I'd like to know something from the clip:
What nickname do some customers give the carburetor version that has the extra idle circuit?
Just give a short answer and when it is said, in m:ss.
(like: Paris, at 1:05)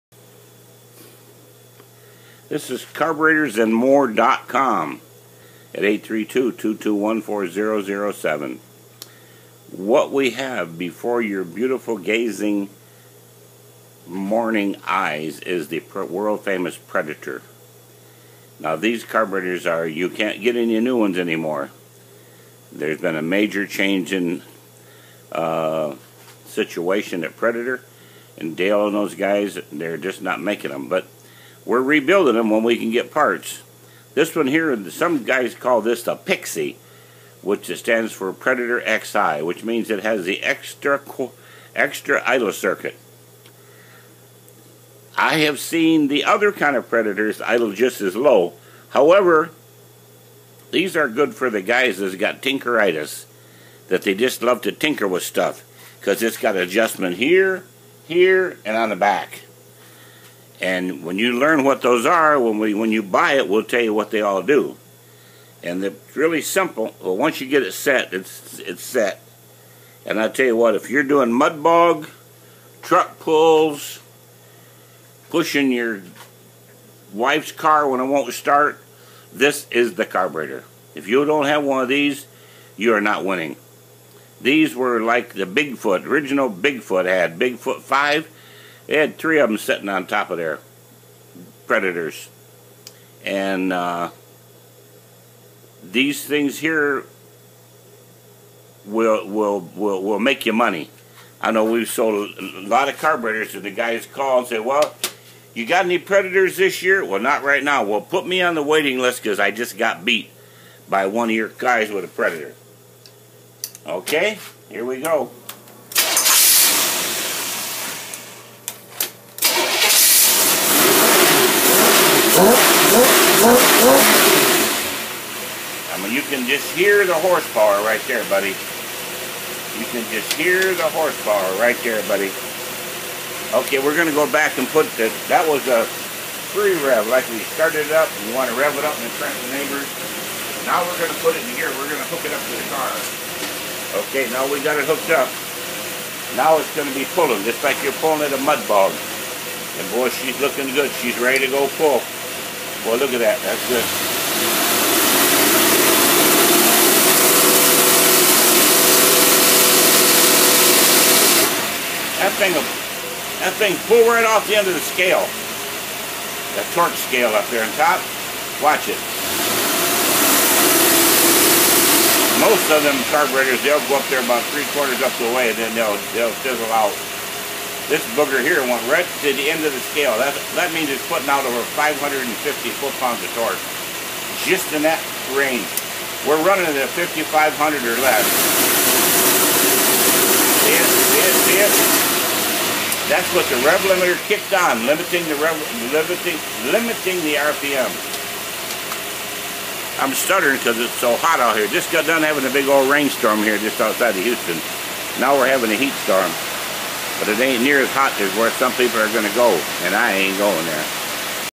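Pixie, at 0:36.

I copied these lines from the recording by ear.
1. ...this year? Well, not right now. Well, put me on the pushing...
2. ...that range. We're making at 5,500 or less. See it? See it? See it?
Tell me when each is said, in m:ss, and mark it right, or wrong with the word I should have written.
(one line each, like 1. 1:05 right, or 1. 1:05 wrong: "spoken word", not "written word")
1. 1:46 wrong: "waiting", not "pushing"
2. 3:04 wrong: "running", not "making".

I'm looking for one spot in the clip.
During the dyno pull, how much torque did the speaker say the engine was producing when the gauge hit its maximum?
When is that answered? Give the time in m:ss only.
3:01.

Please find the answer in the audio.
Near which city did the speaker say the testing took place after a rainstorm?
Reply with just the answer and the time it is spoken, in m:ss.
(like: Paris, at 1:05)
Houston, at 3:24.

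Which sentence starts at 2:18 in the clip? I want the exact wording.
We want to rev it up and front the neighbors.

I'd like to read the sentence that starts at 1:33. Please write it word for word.
And uh, these things here will, will, will, will make you money.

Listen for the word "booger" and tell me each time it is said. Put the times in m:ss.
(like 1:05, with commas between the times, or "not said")
2:58.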